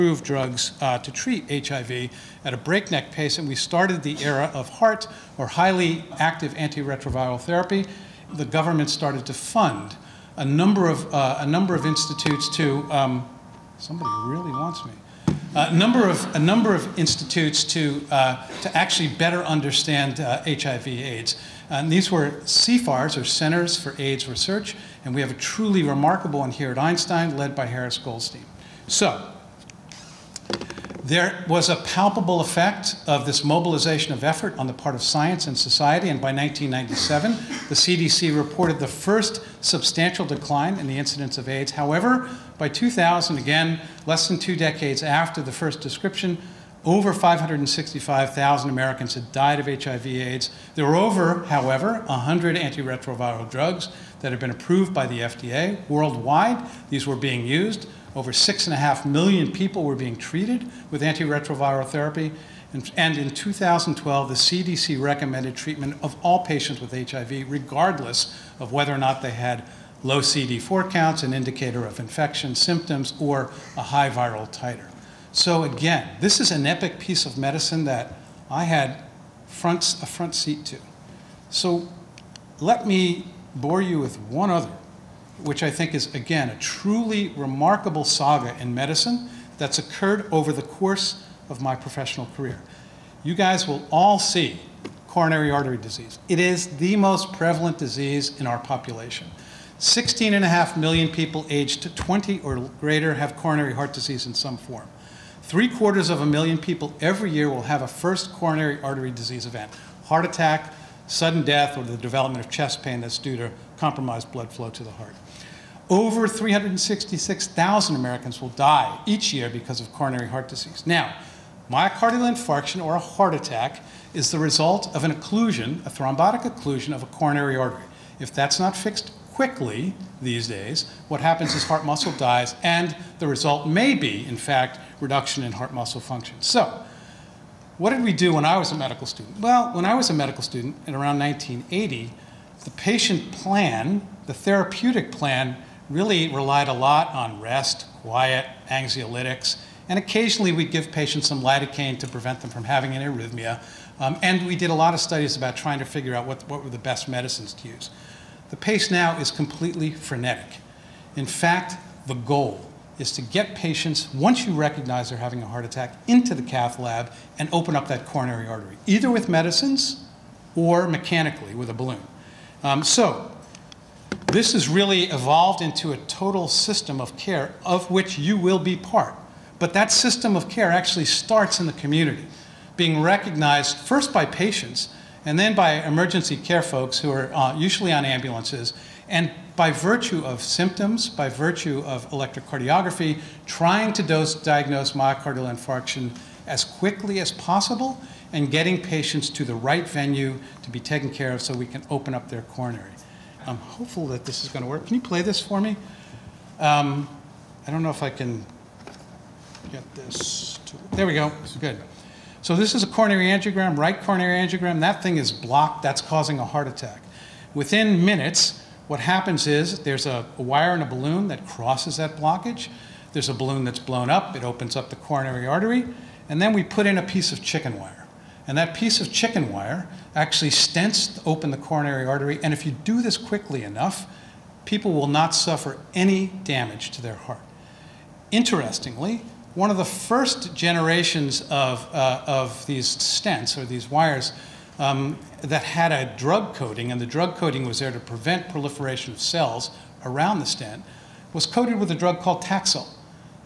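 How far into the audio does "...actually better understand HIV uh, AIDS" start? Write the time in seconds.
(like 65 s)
18 s.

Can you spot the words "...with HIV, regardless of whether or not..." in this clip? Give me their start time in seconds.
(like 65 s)
66 s.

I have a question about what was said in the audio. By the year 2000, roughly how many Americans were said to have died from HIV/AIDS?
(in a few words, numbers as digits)
565,000.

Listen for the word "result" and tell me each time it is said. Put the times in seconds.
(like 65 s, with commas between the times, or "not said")
124 s, 133 s.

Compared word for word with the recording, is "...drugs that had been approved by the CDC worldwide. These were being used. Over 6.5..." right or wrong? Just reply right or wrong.
wrong.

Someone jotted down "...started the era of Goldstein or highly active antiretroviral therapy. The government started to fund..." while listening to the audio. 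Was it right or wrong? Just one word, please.
wrong.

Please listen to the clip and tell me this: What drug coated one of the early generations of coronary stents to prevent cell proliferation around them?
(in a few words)
Taxol.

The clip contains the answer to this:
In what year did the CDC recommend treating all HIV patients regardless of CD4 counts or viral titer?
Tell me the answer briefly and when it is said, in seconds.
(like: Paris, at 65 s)
2012, at 63 s.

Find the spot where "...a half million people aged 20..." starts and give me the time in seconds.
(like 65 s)
100 s.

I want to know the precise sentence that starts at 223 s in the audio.
There's a balloon that's blown up.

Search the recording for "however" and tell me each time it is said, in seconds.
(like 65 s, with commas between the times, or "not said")
41 s, 51 s.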